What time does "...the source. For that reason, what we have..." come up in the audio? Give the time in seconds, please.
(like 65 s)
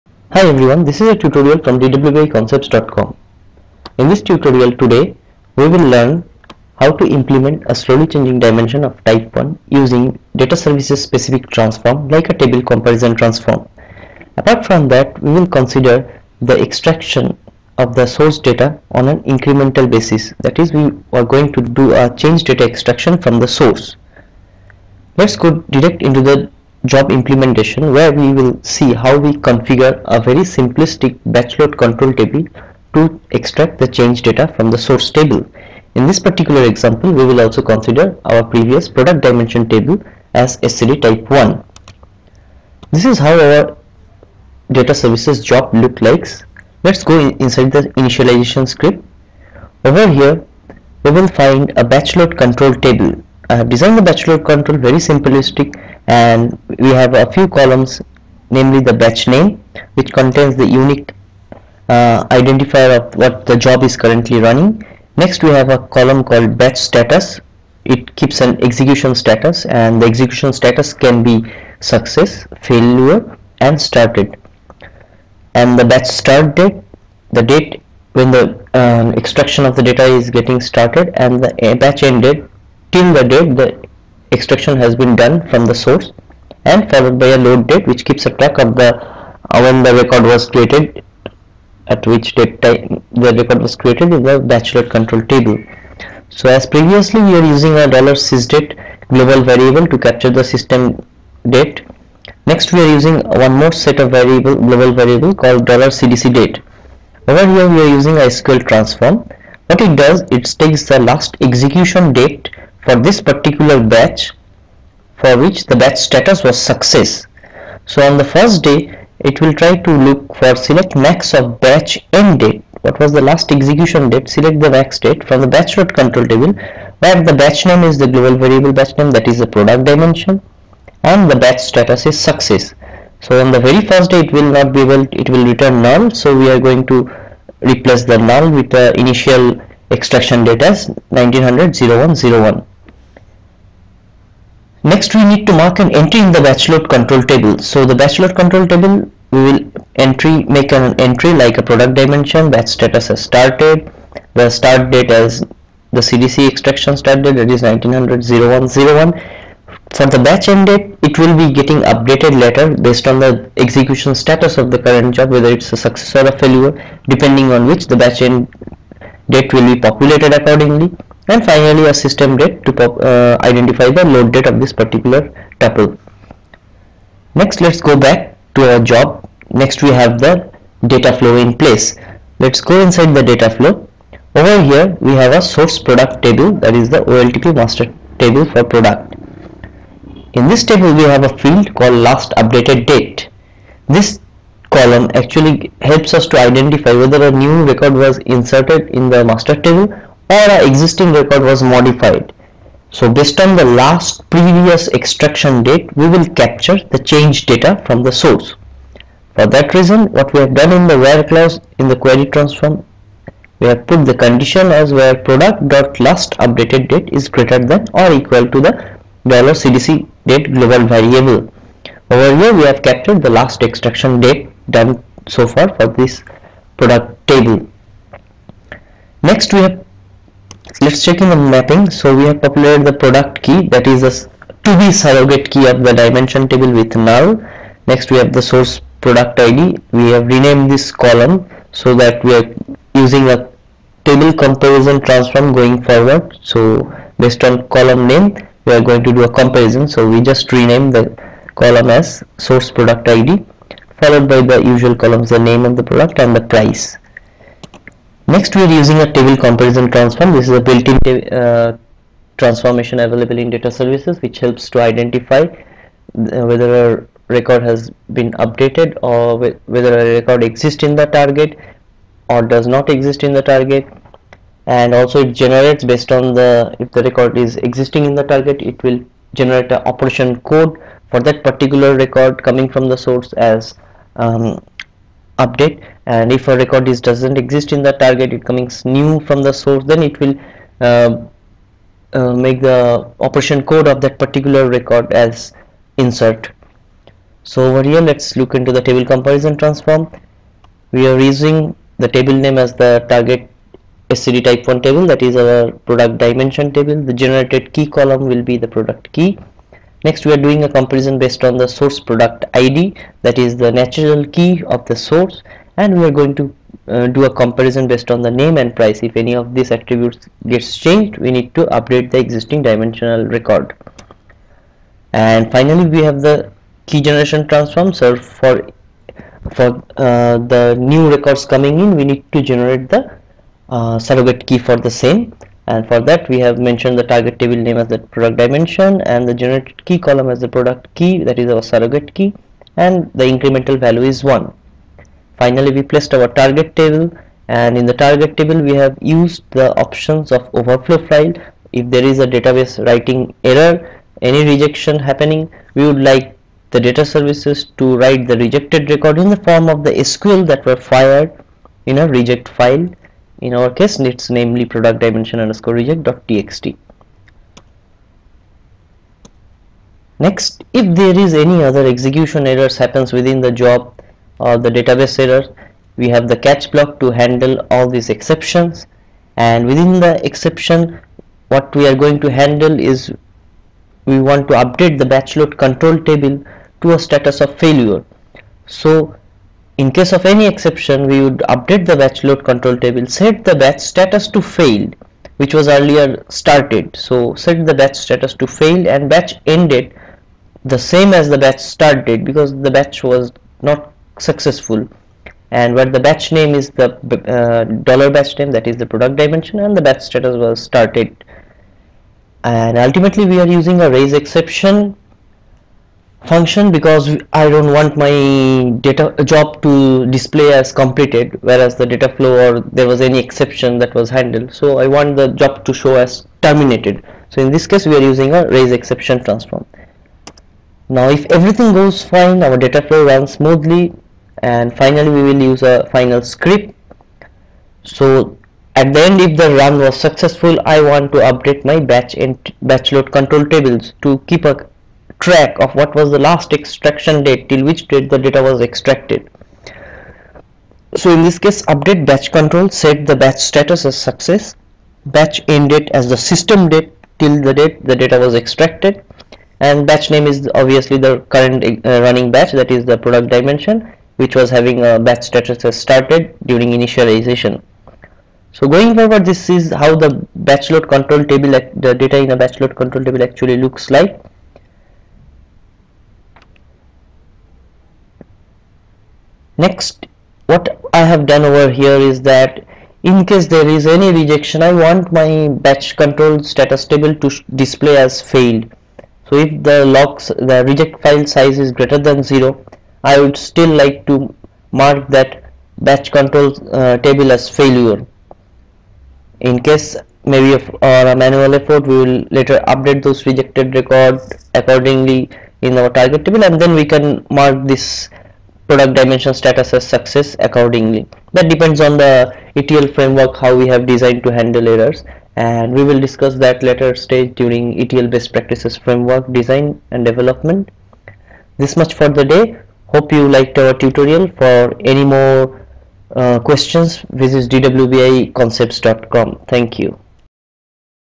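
208 s.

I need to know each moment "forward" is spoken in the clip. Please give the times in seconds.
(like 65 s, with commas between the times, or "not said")
245 s, 468 s.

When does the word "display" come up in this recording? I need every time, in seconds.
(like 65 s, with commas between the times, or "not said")
420 s, 487 s.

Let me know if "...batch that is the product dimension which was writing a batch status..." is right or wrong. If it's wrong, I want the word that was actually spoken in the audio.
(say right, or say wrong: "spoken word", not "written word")
wrong: "having", not "writing".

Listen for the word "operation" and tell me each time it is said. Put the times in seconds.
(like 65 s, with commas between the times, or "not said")
279 s, 293 s.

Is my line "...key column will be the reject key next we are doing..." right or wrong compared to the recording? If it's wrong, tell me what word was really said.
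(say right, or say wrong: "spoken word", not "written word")
wrong: "product", not "reject".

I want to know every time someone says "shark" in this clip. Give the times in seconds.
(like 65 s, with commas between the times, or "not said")
not said.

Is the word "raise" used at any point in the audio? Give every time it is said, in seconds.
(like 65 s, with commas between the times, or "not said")
413 s, 428 s.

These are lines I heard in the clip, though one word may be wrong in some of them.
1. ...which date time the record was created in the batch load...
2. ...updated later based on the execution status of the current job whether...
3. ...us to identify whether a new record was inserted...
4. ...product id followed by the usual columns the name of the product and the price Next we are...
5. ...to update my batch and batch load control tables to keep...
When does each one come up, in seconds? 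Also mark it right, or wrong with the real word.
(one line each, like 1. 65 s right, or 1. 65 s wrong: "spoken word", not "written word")
1. 92 s right
2. 161 s right
3. 196 s right
4. 252 s right
5. 441 s right.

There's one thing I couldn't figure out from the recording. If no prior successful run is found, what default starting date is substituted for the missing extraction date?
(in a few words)
1900-01-01.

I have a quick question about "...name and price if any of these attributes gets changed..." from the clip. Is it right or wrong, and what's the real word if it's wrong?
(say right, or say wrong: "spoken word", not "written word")
right.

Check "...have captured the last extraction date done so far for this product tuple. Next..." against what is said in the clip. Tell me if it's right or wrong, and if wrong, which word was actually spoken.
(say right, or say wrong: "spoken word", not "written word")
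wrong: "table", not "tuple".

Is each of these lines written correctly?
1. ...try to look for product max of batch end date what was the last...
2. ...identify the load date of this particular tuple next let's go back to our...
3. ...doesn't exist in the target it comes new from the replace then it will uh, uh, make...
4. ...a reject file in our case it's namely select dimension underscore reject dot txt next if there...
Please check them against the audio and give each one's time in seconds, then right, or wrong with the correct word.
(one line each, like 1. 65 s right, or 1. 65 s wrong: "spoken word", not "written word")
1. 119 s wrong: "select", not "product"
2. 173 s right
3. 287 s wrong: "source", not "replace"
4. 362 s wrong: "product", not "select".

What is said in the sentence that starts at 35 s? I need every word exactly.
In this particular example, we will also consider our previous product dimension table as SCD type 1.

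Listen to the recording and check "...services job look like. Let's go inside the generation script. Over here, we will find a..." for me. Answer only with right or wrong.
wrong.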